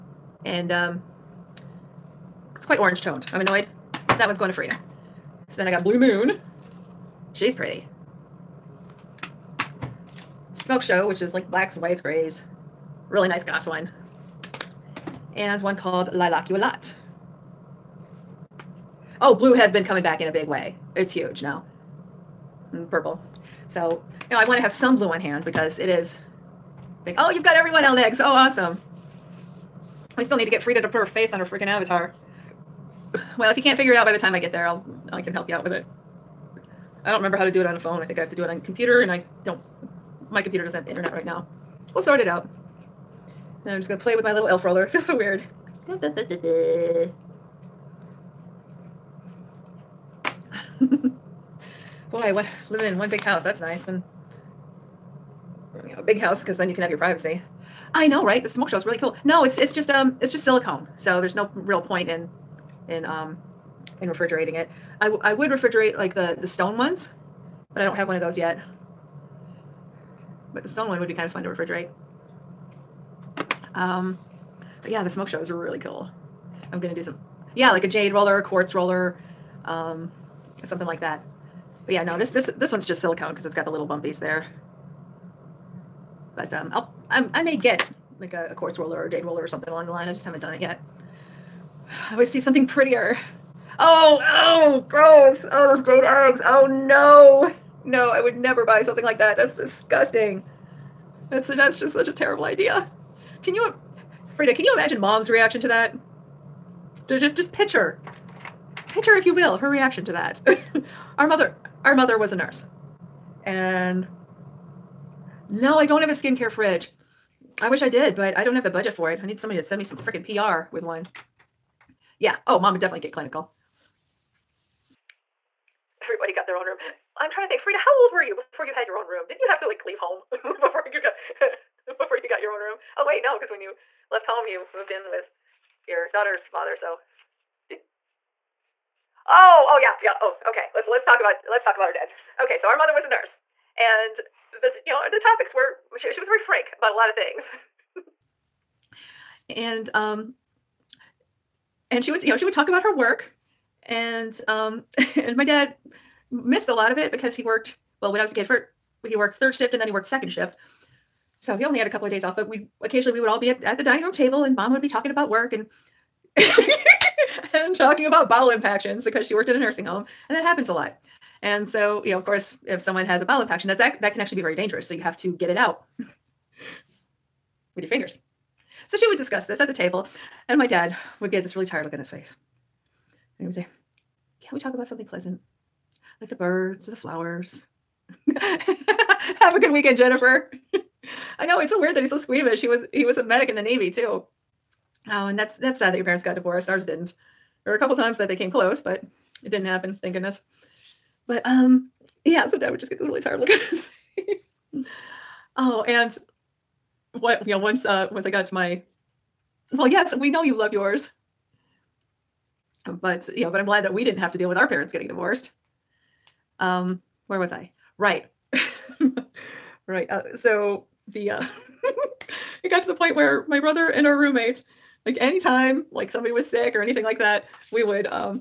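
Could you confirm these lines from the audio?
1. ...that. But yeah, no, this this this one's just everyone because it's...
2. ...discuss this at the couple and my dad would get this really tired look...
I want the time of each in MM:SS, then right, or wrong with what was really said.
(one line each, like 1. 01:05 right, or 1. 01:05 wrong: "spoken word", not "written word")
1. 01:21 wrong: "silicone", not "everyone"
2. 02:59 wrong: "table", not "couple".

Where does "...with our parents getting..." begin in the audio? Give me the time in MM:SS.
03:34.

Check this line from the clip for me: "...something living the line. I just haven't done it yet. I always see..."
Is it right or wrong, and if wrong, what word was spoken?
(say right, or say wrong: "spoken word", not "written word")
wrong: "along", not "living".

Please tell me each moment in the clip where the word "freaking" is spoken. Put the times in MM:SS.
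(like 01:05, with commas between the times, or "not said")
00:31, 01:59.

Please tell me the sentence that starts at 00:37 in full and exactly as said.
I don't remember how to do it on the phone.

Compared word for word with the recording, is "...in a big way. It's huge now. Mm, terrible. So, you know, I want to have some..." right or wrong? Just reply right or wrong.
wrong.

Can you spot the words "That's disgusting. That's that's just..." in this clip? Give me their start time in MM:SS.
01:39.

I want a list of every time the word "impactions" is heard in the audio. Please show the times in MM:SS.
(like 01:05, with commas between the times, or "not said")
02:48, 02:53.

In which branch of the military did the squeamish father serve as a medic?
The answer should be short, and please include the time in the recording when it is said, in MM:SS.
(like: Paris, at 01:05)
Navy, at 03:13.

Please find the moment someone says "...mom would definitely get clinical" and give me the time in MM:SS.
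02:02.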